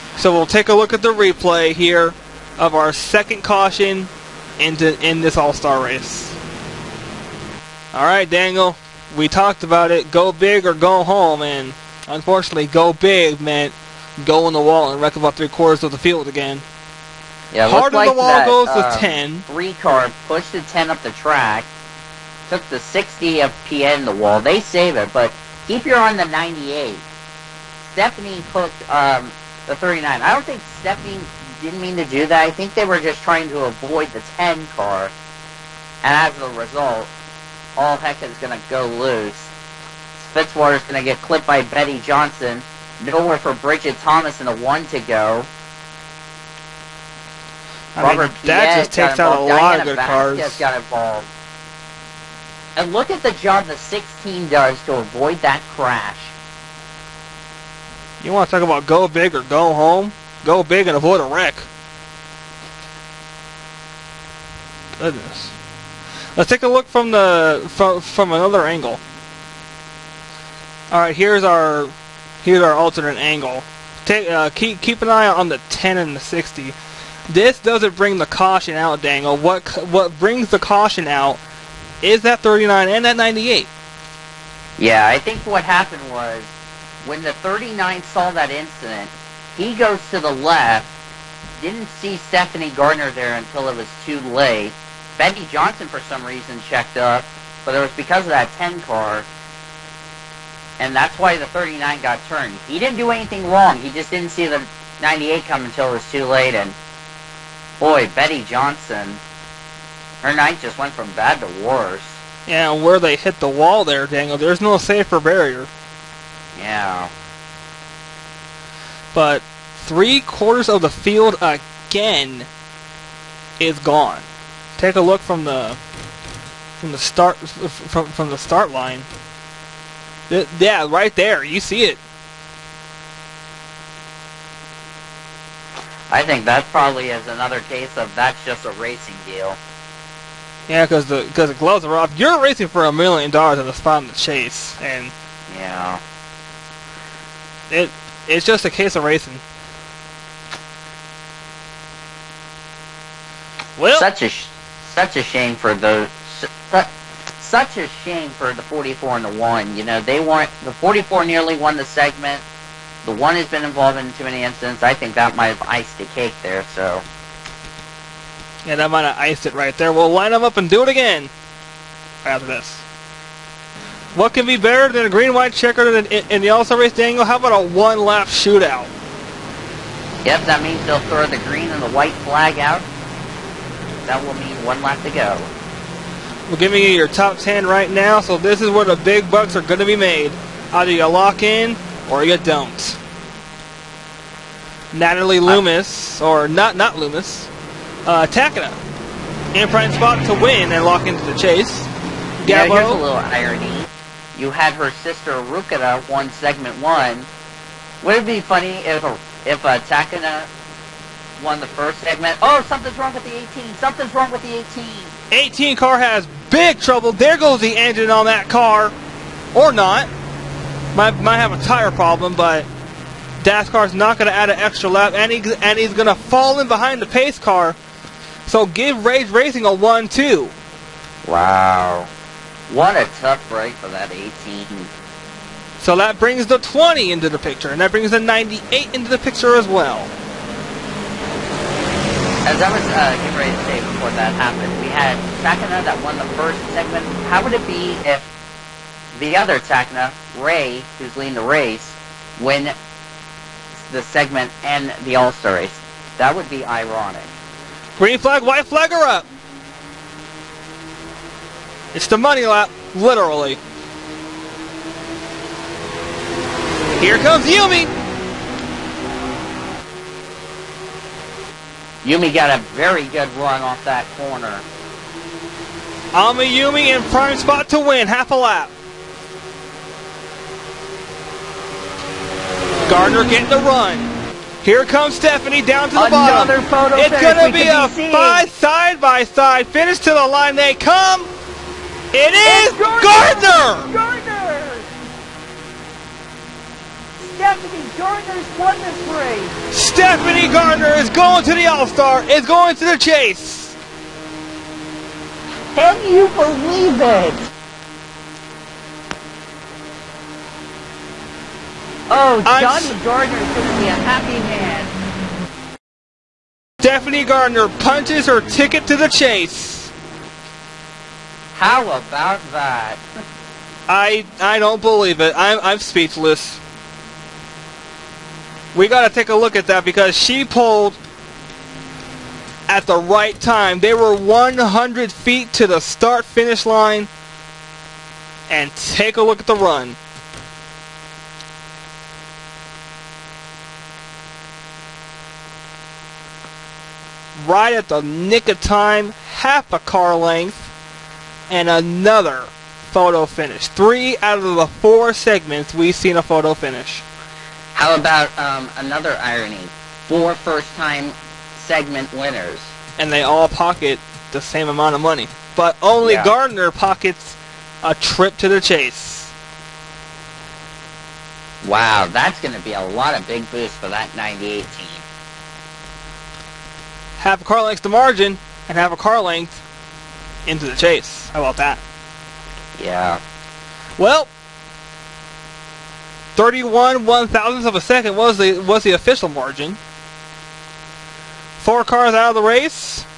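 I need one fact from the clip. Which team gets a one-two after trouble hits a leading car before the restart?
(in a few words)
Rage Racing.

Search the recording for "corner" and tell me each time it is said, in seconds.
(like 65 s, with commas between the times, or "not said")
274 s.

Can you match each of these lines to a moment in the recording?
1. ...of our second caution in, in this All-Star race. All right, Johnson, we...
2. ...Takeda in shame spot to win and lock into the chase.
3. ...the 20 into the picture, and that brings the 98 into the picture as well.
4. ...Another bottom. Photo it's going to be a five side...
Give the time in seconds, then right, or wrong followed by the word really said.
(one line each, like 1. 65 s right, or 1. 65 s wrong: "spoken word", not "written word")
1. 2 s wrong: "Daniel", not "Johnson"
2. 198 s wrong: "prime", not "shame"
3. 236 s right
4. 286 s right.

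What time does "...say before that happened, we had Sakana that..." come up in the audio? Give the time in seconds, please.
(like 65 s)
243 s.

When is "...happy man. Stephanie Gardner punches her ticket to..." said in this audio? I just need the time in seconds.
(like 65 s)
314 s.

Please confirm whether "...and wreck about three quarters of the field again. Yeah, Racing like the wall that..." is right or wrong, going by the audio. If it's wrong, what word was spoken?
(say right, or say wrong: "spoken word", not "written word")
wrong: "Hard", not "Racing".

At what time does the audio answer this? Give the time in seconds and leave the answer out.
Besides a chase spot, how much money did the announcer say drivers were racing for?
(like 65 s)
142 s.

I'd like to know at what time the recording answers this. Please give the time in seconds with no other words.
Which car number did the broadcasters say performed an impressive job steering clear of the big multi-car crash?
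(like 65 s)
53 s.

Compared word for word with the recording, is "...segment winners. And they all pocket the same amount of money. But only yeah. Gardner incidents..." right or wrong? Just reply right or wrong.
wrong.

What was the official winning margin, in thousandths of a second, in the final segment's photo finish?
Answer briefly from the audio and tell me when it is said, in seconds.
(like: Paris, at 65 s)
31, at 386 s.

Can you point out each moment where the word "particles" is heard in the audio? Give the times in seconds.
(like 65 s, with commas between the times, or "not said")
not said.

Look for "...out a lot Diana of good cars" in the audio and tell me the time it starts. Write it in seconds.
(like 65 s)
49 s.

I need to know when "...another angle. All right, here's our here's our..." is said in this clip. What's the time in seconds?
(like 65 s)
68 s.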